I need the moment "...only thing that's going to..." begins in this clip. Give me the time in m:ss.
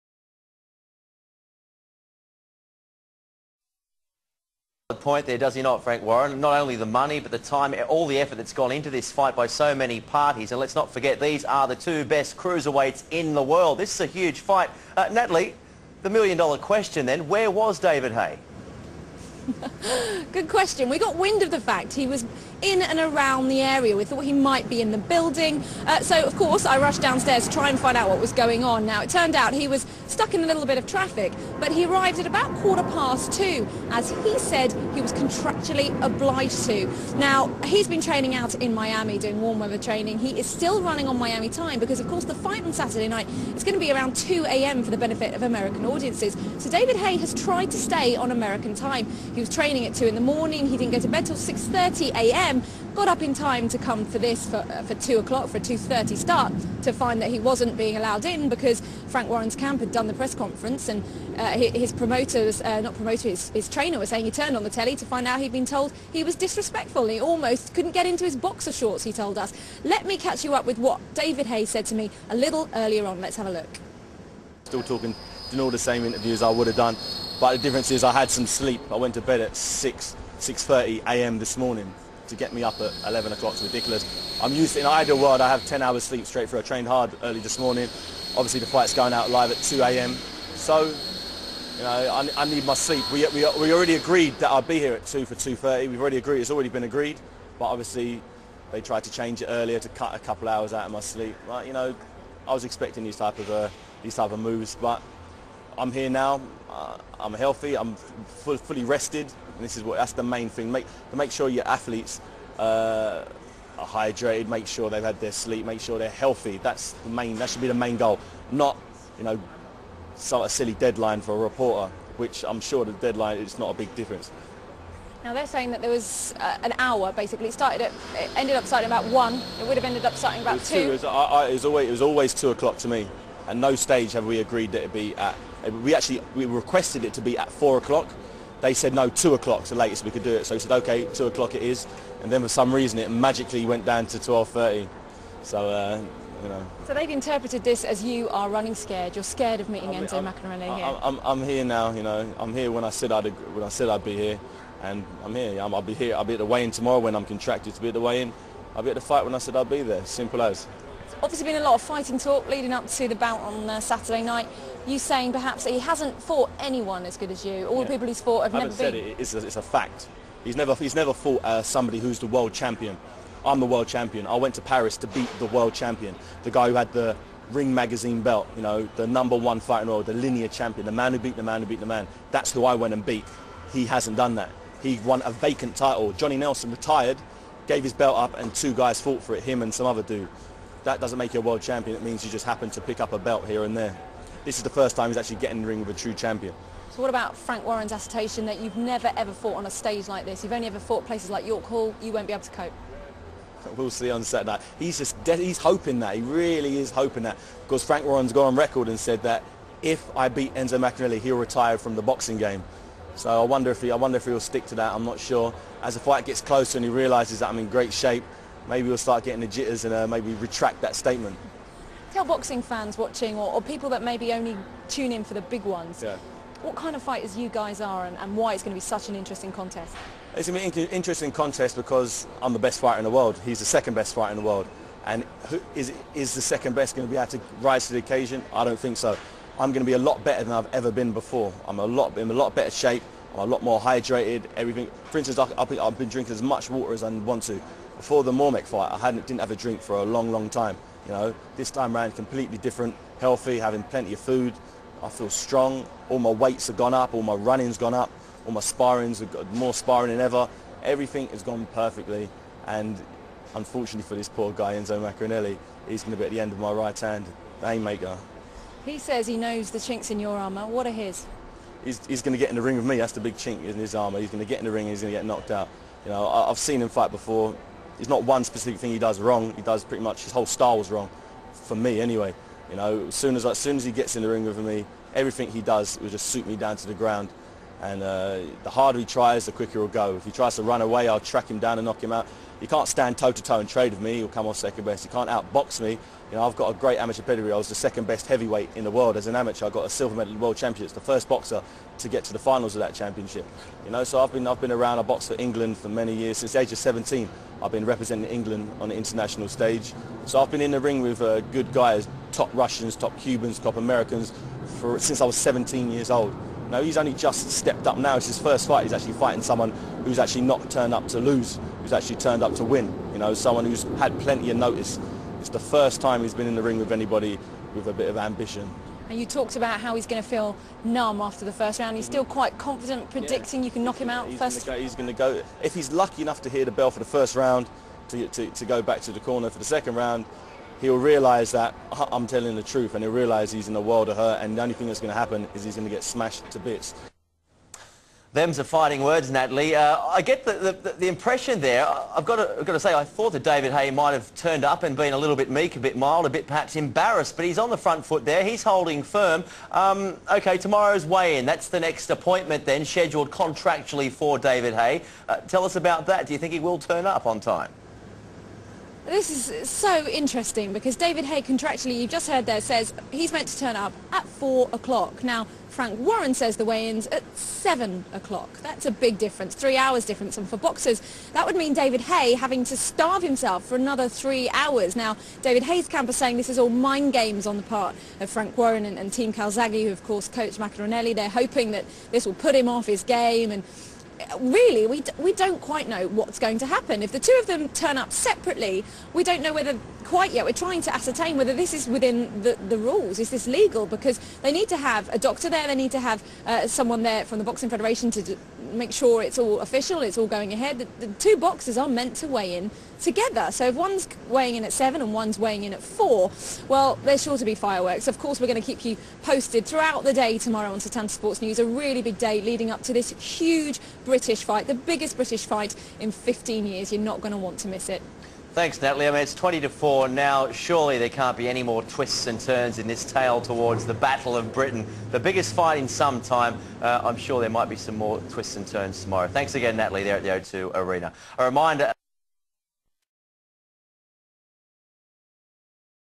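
5:44.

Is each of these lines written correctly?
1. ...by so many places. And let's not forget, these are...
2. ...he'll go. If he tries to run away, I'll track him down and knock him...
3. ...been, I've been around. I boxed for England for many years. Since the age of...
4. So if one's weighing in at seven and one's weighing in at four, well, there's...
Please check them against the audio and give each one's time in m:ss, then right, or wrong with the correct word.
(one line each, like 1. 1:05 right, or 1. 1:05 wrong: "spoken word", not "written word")
1. 0:09 wrong: "parties", not "places"
2. 4:49 right
3. 5:04 right
4. 6:53 right.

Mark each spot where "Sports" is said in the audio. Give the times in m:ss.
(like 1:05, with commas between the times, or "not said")
7:01.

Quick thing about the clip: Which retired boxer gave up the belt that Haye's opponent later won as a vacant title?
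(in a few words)
Johnny Nelson.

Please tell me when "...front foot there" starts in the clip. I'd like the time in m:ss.
5:57.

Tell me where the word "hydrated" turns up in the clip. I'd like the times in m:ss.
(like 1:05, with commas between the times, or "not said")
1:53, 4:03.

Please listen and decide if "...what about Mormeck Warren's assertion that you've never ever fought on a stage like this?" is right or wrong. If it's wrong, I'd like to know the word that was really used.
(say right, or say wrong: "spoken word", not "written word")
wrong: "Frank", not "Mormeck".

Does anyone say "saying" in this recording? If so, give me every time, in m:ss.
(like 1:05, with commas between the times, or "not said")
1:04, 2:05, 2:44, 6:26.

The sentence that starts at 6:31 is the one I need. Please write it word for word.
They're hoping that this will put him off his game and really, we, we don't quite know what's going to happen.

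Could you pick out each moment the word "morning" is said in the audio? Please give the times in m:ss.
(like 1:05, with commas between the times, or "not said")
0:50, 1:21, 1:27.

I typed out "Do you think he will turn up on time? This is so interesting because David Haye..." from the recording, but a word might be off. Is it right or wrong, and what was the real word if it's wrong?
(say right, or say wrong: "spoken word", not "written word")
right.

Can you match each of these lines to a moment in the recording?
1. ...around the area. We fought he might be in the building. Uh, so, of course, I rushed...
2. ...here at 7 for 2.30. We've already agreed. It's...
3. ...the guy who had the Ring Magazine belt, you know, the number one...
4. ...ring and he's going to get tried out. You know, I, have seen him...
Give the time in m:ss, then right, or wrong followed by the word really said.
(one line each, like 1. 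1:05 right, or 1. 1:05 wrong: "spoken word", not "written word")
1. 0:22 wrong: "thought", not "fought"
2. 1:34 wrong: "2", not "7"
3. 2:56 right
4. 4:34 wrong: "knocked", not "tried".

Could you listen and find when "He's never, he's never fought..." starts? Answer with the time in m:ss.
2:50.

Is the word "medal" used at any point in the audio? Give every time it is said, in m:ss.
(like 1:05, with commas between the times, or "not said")
5:00.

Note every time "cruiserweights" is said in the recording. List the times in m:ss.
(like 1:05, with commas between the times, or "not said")
0:12.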